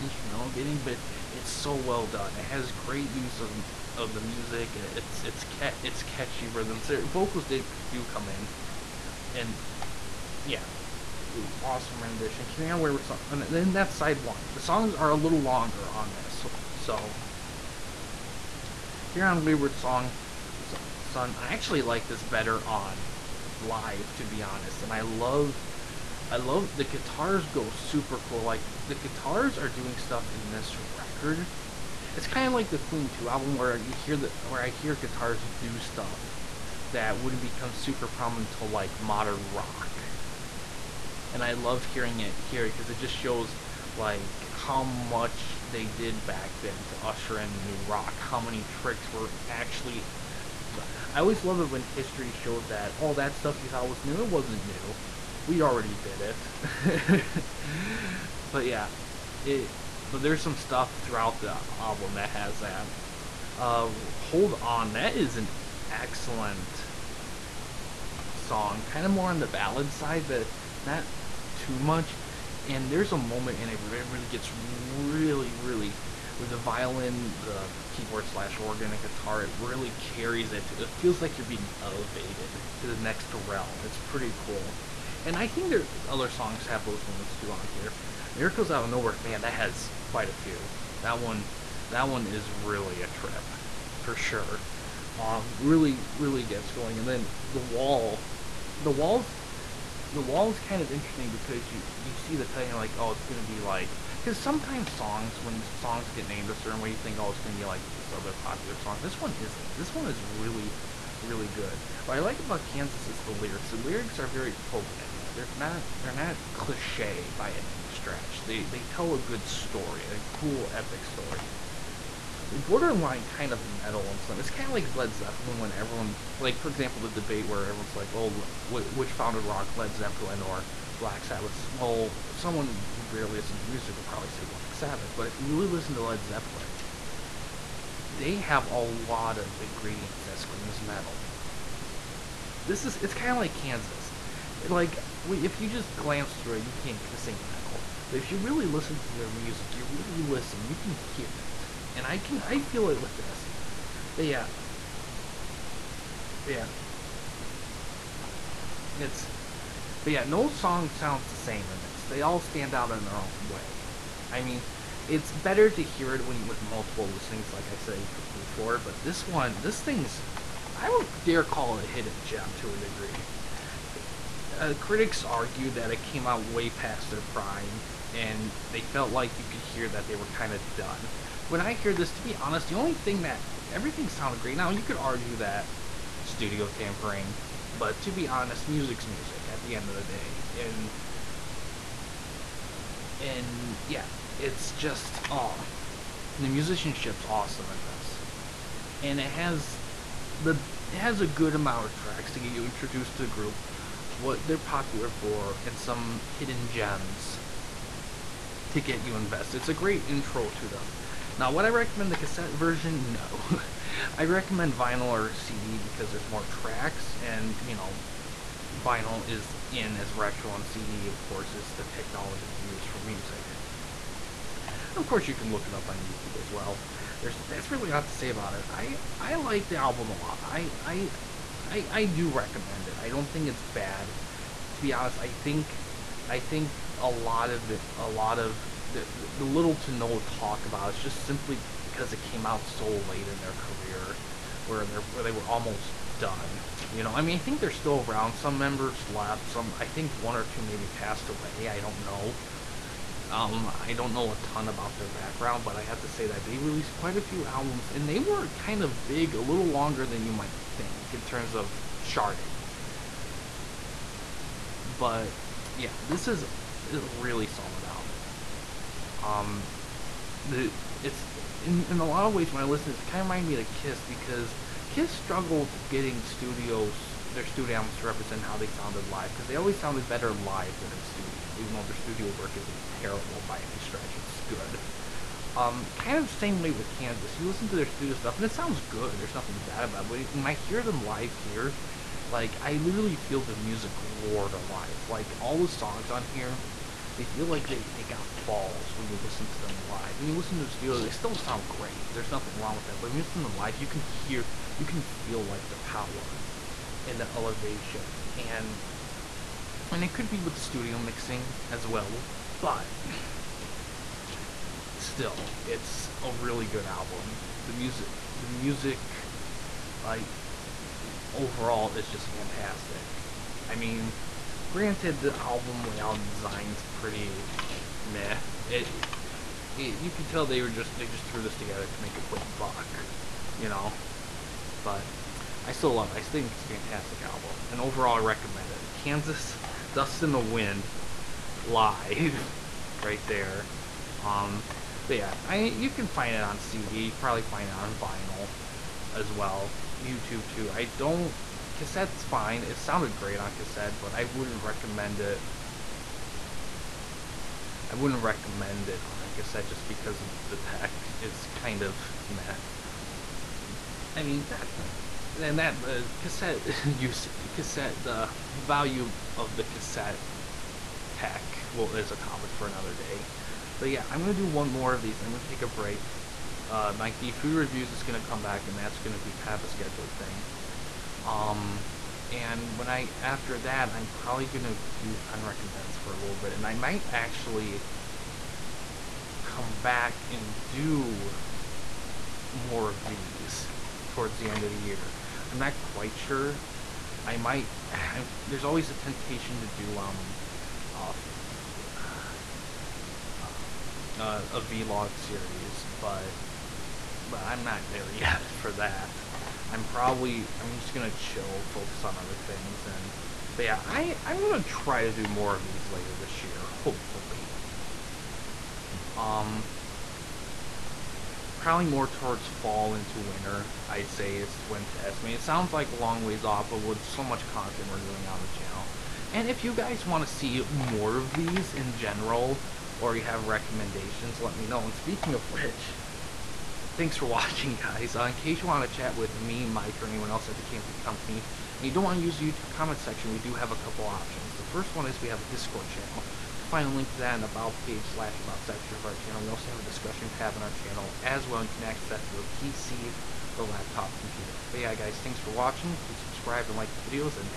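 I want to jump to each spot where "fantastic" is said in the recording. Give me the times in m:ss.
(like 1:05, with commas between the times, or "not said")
5:22, 5:36.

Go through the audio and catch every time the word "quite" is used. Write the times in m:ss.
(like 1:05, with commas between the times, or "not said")
1:30, 4:16, 6:35.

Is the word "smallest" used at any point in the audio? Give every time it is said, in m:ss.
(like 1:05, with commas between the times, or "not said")
not said.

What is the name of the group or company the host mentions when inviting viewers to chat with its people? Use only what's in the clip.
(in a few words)
Campy Company.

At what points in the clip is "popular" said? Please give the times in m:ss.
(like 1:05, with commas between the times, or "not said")
1:48, 3:24.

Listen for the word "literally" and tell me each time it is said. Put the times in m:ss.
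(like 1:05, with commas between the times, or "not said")
4:52.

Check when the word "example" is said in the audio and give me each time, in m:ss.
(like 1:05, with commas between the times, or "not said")
2:06.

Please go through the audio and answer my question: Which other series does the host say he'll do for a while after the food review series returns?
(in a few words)
Fun Recommends.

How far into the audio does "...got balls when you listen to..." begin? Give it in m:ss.
4:58.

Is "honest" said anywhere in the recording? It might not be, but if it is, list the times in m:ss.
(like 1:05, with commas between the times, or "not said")
0:24, 3:02, 3:08, 3:54.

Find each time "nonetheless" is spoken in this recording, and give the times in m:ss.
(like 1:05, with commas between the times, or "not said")
not said.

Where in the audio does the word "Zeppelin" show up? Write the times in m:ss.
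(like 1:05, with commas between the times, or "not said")
2:05, 2:09, 2:16.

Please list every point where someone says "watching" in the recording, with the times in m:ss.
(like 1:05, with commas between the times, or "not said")
7:17, 7:35.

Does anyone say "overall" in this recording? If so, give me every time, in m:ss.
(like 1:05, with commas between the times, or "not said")
5:21, 5:37.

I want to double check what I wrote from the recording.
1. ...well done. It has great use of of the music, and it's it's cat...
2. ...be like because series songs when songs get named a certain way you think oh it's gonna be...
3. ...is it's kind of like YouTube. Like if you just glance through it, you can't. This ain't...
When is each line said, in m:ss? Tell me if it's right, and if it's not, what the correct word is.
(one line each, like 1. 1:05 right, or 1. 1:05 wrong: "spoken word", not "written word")
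1. 0:01 right
2. 1:43 wrong: "sometimes", not "series"
3. 2:22 wrong: "Kansas", not "YouTube".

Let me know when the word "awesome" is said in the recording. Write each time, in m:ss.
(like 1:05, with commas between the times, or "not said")
0:11, 3:17.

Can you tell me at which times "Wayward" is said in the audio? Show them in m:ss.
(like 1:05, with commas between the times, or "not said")
0:12, 0:19.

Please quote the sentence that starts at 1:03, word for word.
Uh, Hold on, that is an excellent song.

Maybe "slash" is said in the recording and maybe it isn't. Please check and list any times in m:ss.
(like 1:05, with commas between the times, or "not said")
1:18, 7:28.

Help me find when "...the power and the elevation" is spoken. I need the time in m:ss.
5:05.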